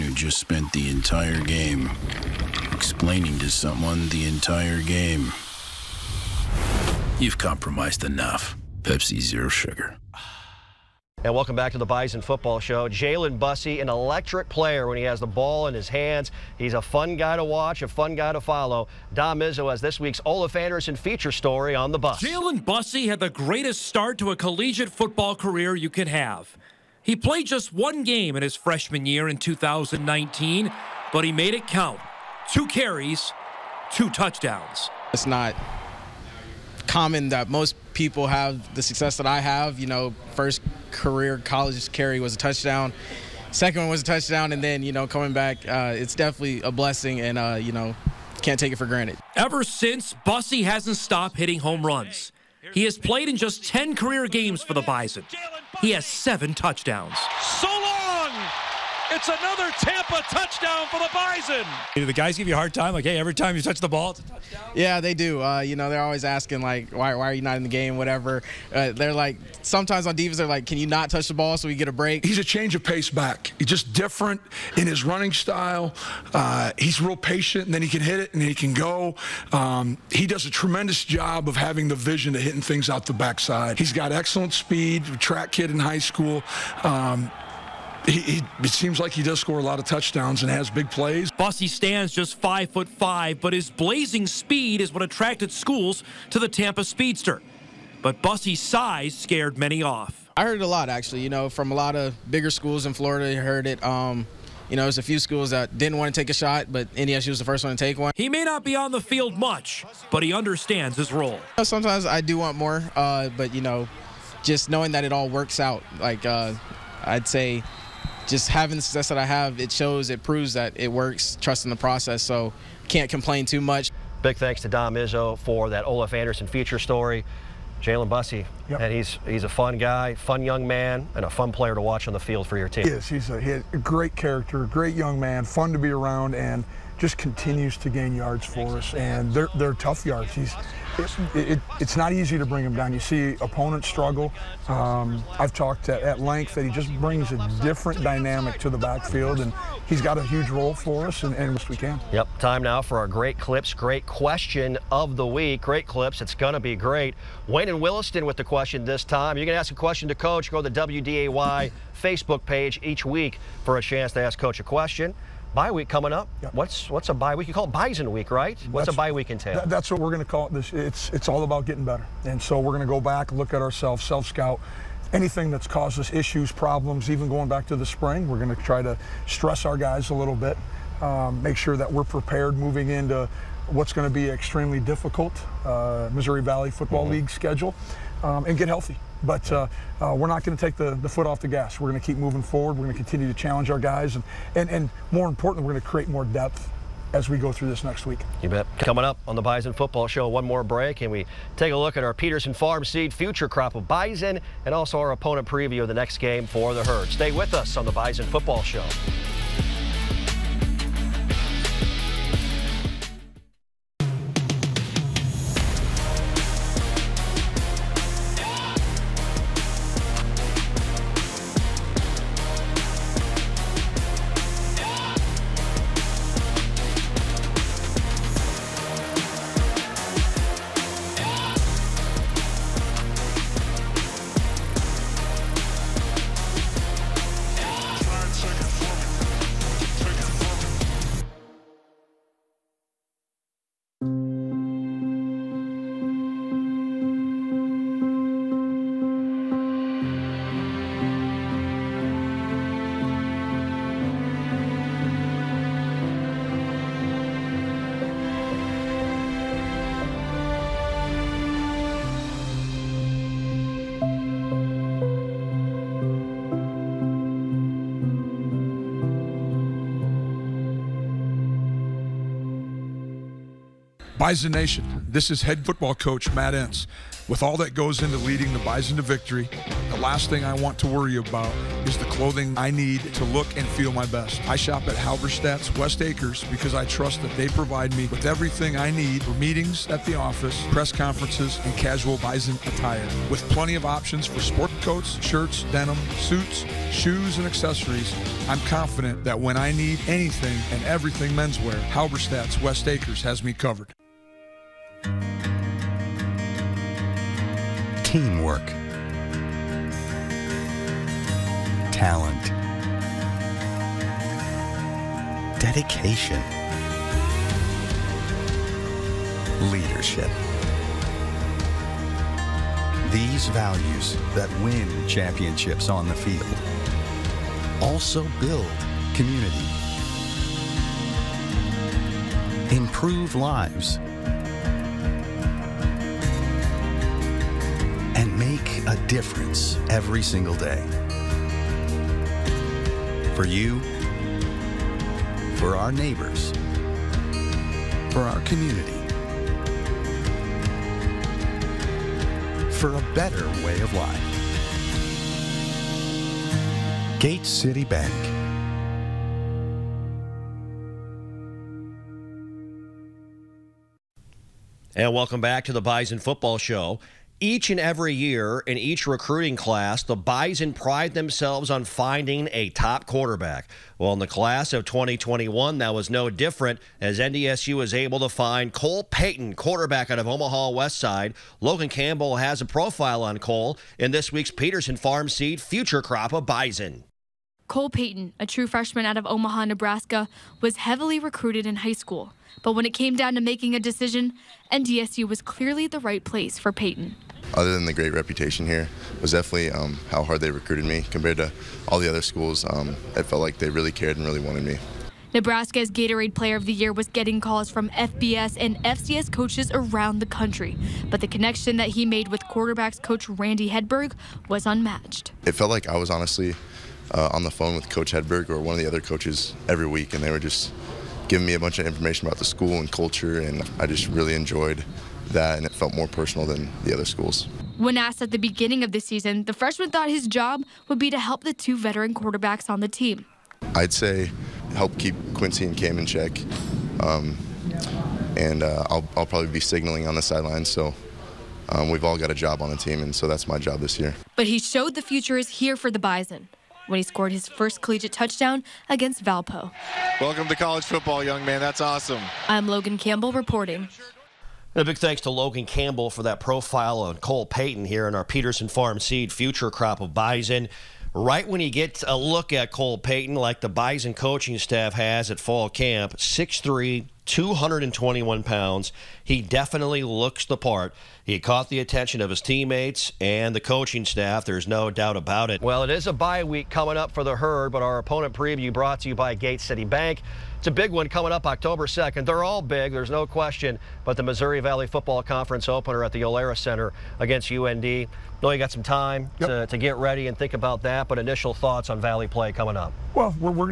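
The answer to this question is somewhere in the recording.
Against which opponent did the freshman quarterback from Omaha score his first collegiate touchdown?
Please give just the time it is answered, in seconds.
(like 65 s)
449 s.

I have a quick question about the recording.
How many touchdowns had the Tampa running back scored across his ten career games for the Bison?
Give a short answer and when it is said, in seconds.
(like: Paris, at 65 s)
7, at 56 s.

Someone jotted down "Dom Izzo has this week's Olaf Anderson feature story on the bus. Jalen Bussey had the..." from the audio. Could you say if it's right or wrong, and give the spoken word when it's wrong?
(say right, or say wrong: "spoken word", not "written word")
right.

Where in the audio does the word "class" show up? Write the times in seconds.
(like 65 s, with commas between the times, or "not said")
369 s, 374 s.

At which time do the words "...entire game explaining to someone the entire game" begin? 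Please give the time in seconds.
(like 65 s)
0 s.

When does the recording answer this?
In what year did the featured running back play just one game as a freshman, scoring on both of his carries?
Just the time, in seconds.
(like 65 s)
29 s.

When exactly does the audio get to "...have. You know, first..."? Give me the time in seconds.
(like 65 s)
39 s.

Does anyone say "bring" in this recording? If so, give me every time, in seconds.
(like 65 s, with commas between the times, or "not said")
142 s, 146 s.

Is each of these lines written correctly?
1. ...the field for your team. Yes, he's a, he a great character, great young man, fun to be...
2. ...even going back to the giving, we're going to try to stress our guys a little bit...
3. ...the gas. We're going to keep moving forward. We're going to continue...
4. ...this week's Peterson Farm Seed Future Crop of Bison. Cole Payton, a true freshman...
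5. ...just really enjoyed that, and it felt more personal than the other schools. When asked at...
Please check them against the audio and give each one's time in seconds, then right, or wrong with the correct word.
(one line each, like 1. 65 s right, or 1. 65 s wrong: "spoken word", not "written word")
1. 132 s right
2. 177 s wrong: "spring", not "giving"
3. 191 s right
4. 384 s right
5. 423 s right.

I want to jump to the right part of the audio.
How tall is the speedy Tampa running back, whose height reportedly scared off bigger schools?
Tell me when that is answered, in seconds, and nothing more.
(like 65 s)
92 s.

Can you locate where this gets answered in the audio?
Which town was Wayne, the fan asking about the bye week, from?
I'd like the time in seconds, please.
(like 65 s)
157 s.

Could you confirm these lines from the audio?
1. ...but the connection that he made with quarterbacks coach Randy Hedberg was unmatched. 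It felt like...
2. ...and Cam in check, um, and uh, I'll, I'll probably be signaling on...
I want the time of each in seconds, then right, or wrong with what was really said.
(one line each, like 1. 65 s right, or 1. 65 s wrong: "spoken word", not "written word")
1. 411 s right
2. 435 s right.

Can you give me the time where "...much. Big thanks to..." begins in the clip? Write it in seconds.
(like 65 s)
123 s.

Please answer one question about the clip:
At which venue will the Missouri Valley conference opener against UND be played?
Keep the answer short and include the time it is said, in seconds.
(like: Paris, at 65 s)
Alerus Center, at 486 s.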